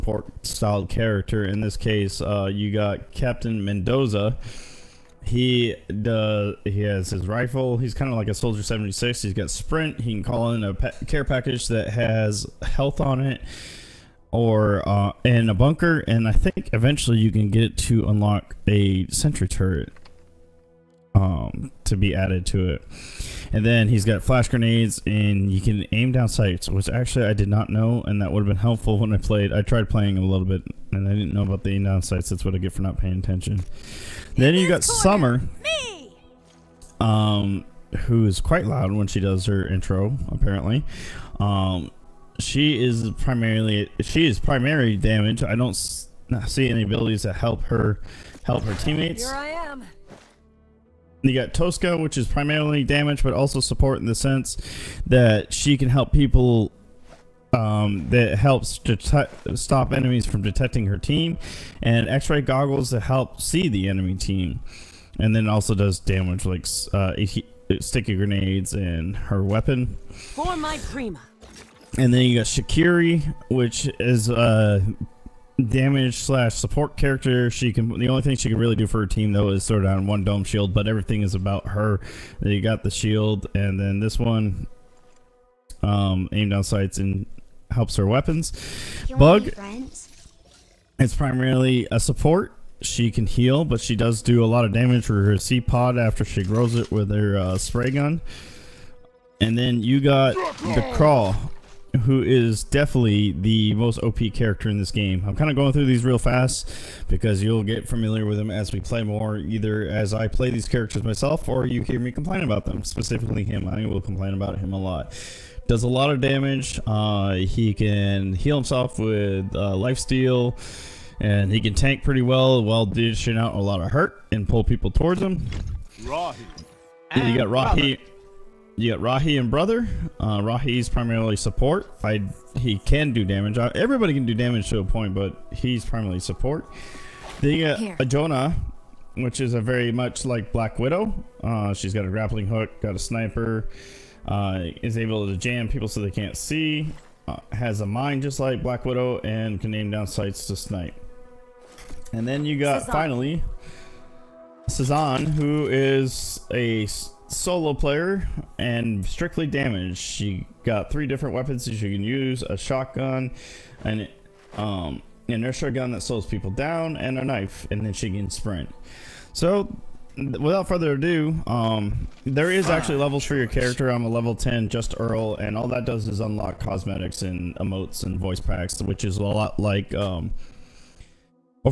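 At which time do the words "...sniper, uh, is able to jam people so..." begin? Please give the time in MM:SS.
02:22.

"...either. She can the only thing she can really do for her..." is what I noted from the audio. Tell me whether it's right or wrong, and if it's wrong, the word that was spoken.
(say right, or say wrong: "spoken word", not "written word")
wrong: "character", not "either".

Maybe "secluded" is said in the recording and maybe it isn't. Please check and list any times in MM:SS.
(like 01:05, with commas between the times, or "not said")
not said.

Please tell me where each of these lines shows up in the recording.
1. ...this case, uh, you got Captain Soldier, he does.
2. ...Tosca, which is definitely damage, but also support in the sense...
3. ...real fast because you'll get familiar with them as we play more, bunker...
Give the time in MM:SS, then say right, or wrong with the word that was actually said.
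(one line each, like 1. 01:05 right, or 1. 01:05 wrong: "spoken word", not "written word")
1. 00:01 wrong: "Mendoza", not "Soldier"
2. 00:51 wrong: "primarily", not "definitely"
3. 01:46 wrong: "either", not "bunker".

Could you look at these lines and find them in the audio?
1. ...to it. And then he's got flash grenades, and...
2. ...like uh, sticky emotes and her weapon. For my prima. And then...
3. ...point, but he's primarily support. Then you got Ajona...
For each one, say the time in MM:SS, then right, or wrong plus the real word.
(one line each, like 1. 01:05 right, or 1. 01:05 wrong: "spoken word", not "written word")
1. 00:22 right
2. 01:06 wrong: "grenades", not "emotes"
3. 02:14 right.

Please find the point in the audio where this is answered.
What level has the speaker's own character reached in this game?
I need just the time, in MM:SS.
02:54.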